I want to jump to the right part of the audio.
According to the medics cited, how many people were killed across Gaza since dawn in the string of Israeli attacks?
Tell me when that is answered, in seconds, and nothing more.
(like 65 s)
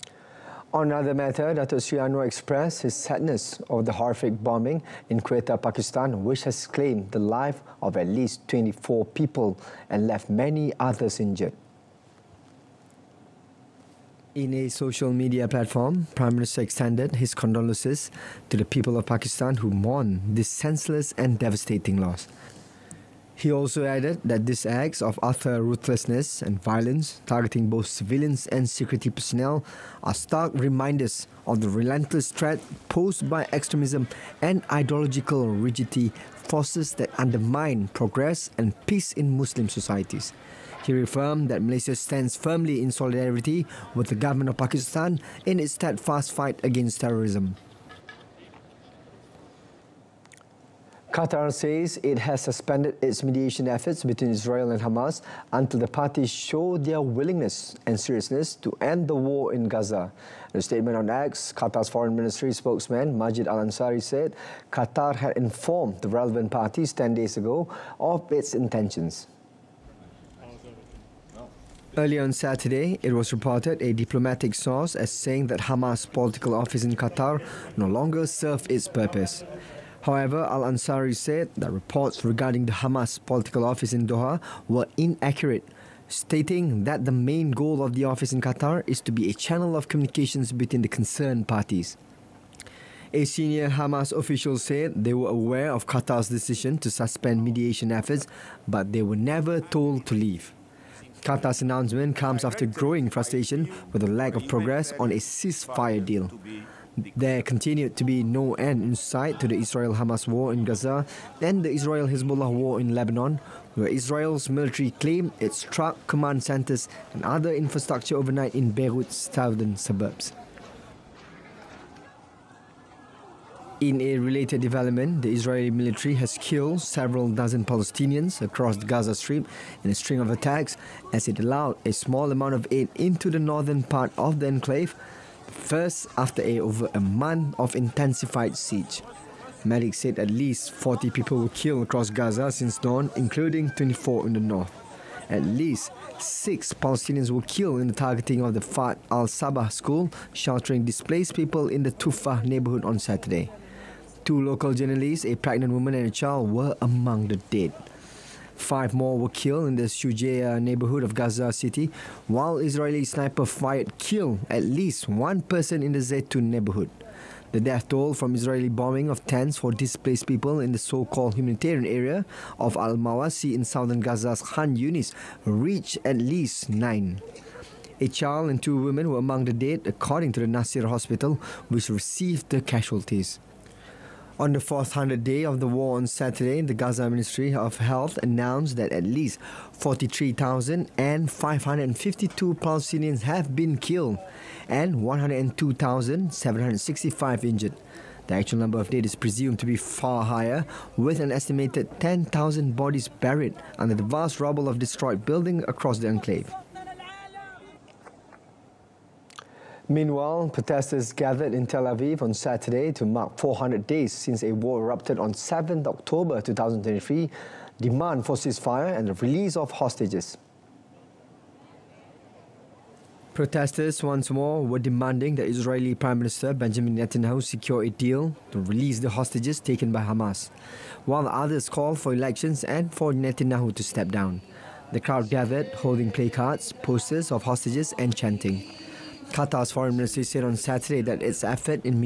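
140 s.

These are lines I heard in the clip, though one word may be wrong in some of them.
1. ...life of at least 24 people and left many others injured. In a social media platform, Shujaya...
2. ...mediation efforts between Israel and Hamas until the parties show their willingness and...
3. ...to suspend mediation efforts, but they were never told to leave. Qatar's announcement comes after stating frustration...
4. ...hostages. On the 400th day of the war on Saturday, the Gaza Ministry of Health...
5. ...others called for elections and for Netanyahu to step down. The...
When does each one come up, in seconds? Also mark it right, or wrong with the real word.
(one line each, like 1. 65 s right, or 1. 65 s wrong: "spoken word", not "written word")
1. 7 s wrong: "Prime", not "Shujaya"
2. 53 s right
3. 96 s wrong: "growing", not "stating"
4. 182 s wrong: "casualties", not "hostages"
5. 231 s right.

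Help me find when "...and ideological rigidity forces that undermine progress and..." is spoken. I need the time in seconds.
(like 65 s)
34 s.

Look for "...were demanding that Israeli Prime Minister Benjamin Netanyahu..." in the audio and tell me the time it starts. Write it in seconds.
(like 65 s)
224 s.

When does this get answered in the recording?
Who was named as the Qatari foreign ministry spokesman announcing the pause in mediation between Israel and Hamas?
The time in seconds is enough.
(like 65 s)
63 s.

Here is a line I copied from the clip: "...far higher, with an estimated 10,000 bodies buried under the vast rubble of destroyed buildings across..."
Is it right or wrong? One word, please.
right.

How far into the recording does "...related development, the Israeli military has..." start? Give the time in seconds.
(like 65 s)
124 s.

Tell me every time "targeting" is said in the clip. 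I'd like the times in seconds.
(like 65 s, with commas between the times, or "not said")
27 s, 147 s.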